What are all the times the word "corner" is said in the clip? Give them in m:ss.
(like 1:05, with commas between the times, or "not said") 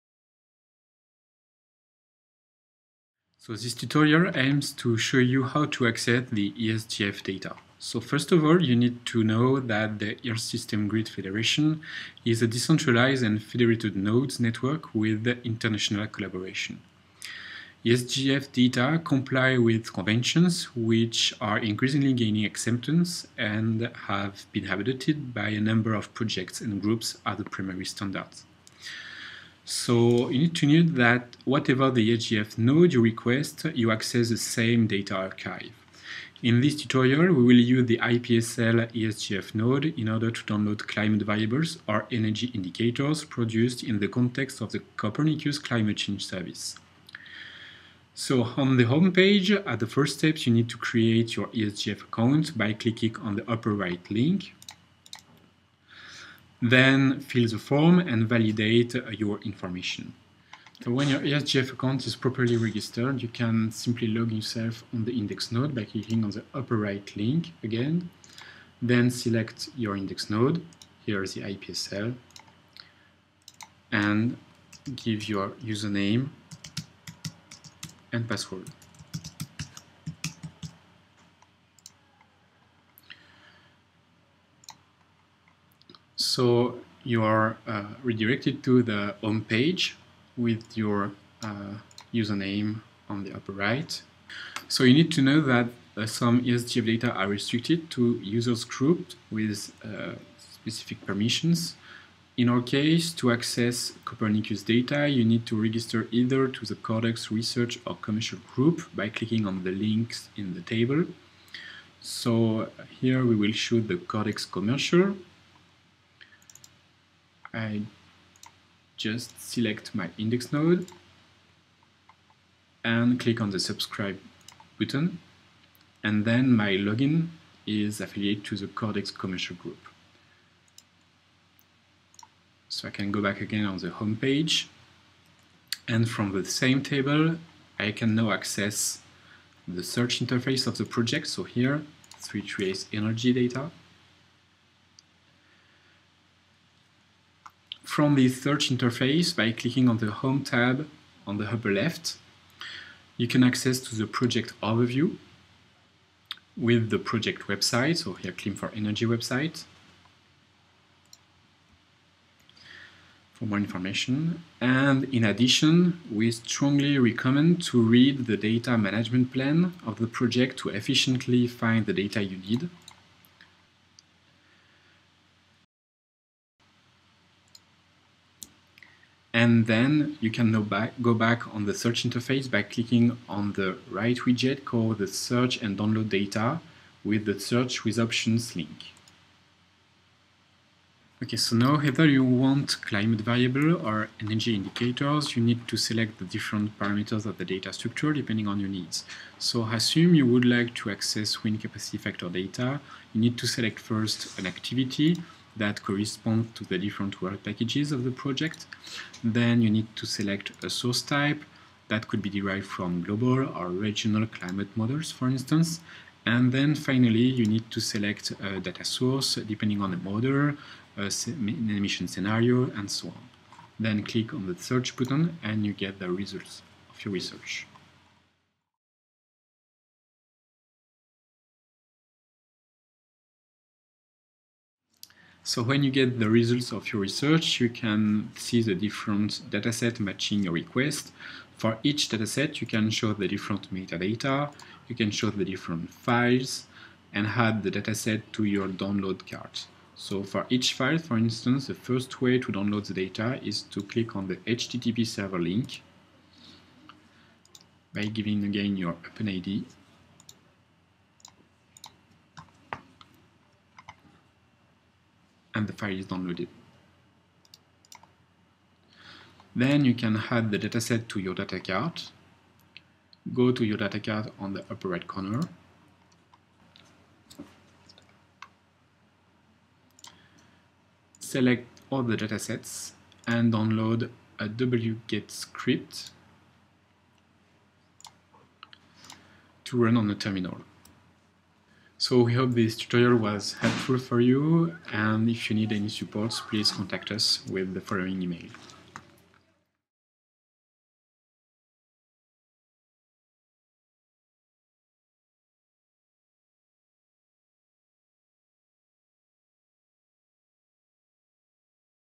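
4:35.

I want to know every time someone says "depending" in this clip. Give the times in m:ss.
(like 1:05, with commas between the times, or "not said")
3:18, 3:39.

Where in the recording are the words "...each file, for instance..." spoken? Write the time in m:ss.
4:10.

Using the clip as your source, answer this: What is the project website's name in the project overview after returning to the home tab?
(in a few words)
CLIM4ENERGY.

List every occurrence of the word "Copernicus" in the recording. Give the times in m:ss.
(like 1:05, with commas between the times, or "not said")
0:44, 1:44.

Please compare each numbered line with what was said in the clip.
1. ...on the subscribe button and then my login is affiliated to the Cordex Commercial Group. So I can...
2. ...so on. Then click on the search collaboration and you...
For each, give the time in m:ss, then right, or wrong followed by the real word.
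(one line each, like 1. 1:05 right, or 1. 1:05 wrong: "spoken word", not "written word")
1. 2:03 right
2. 3:42 wrong: "button", not "collaboration".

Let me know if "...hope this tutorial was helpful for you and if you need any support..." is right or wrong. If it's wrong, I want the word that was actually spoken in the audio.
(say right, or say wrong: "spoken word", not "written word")
right.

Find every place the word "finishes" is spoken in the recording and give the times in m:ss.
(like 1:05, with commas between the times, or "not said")
not said.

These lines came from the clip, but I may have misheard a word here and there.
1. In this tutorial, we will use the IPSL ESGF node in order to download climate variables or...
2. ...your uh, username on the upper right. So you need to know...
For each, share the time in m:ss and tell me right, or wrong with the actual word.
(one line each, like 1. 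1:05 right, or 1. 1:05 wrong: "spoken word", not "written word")
1. 0:36 right
2. 1:30 right.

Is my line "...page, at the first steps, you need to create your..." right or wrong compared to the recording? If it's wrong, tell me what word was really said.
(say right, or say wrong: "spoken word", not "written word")
right.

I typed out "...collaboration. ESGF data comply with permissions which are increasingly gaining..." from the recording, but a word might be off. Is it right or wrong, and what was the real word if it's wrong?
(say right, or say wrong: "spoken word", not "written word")
wrong: "conventions", not "permissions".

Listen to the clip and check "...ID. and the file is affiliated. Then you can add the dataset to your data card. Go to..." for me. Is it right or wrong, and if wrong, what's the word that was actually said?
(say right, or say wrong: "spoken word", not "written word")
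wrong: "downloaded", not "affiliated".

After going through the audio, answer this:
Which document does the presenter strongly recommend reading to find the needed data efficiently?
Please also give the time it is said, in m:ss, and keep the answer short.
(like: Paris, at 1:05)
data management plan, at 2:48.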